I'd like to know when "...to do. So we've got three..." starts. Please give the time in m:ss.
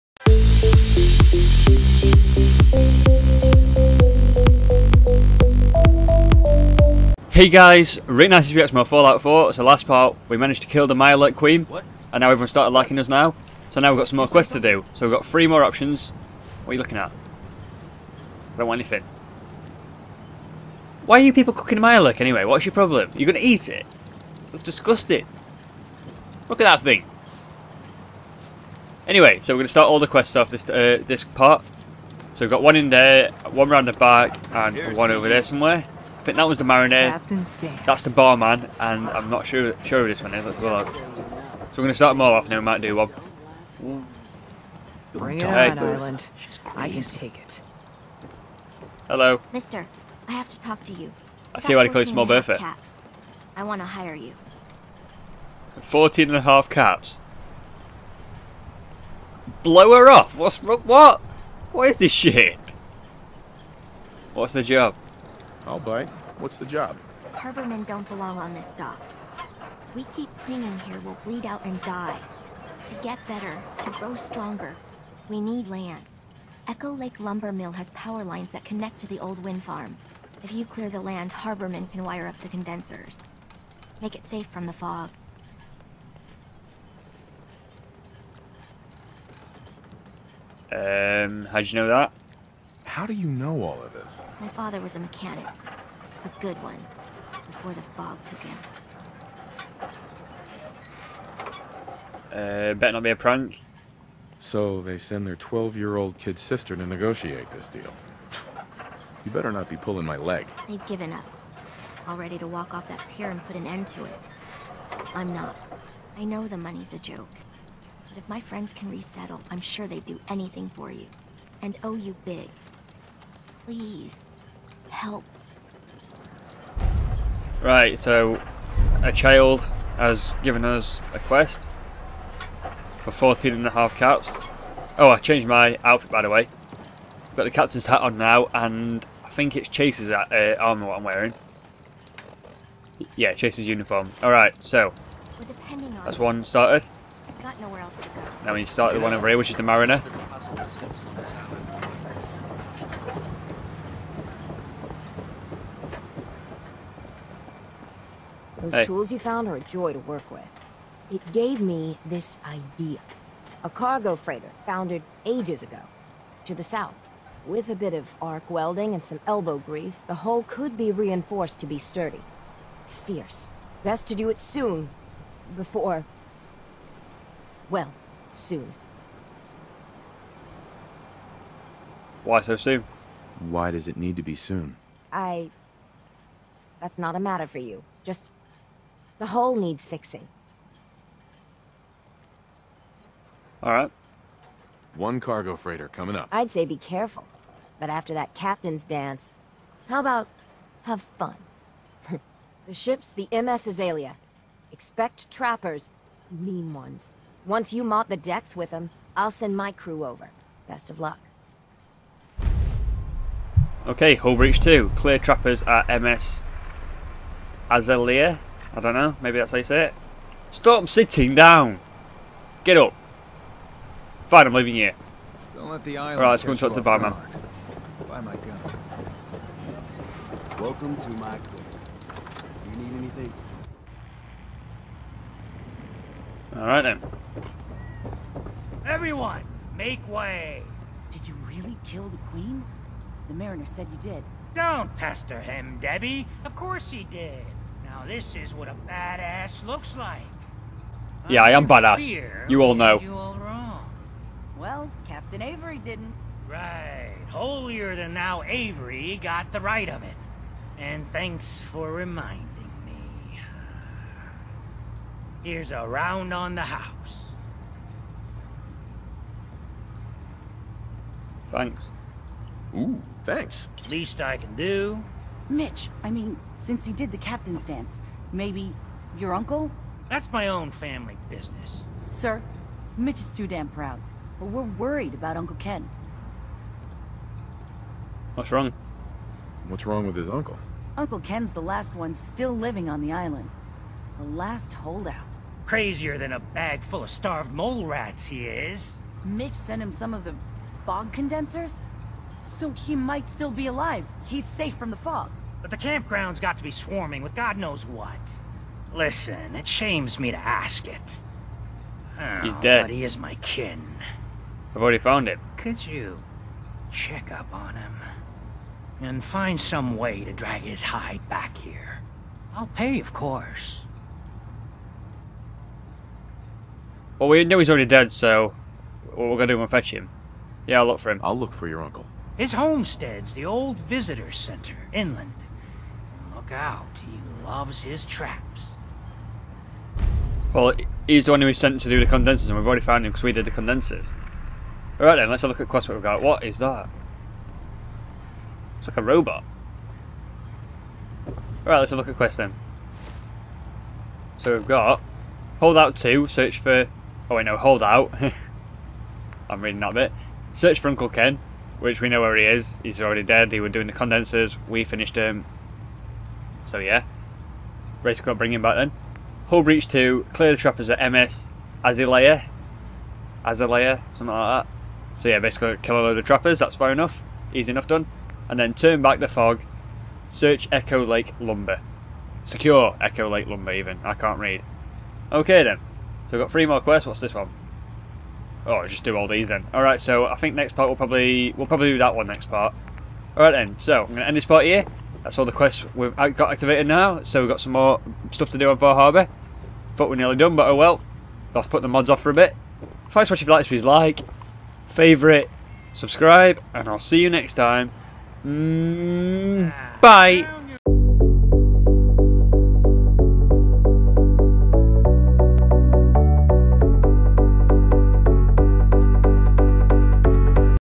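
0:14.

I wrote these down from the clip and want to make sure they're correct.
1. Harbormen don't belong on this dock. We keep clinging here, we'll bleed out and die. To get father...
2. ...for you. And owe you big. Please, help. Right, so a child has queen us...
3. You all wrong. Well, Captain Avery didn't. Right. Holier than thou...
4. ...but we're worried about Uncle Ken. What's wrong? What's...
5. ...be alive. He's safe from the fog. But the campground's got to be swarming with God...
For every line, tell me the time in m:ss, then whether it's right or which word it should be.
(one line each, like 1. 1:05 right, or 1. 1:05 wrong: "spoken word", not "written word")
1. 1:07 wrong: "better", not "father"
2. 2:00 wrong: "given", not "queen"
3. 4:12 right
4. 4:44 right
5. 5:03 right.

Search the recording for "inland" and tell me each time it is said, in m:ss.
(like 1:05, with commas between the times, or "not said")
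5:34.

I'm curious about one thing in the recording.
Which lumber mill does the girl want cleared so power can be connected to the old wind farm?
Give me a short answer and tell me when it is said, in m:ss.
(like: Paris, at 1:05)
Echo Lake Lumber Mill, at 1:16.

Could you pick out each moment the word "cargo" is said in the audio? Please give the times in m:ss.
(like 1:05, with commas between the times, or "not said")
2:43, 3:15.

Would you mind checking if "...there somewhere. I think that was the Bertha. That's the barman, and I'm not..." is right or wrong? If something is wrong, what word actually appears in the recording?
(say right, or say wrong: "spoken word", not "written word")
wrong: "Mariner", not "Bertha".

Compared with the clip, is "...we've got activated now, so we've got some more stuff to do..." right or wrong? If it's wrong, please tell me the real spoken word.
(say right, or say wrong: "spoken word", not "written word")
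right.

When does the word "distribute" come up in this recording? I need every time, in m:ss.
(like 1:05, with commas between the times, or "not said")
not said.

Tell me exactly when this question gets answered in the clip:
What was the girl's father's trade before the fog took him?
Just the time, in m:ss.
1:34.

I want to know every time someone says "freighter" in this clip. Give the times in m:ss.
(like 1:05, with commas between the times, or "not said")
2:44, 3:15.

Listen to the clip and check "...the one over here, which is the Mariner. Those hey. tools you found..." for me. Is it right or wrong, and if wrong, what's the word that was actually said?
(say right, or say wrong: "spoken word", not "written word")
right.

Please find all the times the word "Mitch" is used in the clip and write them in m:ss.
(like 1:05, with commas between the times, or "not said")
4:35, 4:42, 4:59.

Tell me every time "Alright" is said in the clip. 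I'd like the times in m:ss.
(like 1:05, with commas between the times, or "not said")
2:24, 5:44, 5:51.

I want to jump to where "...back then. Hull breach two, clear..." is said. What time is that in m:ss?
6:08.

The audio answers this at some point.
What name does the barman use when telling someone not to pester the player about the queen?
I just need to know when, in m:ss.
4:05.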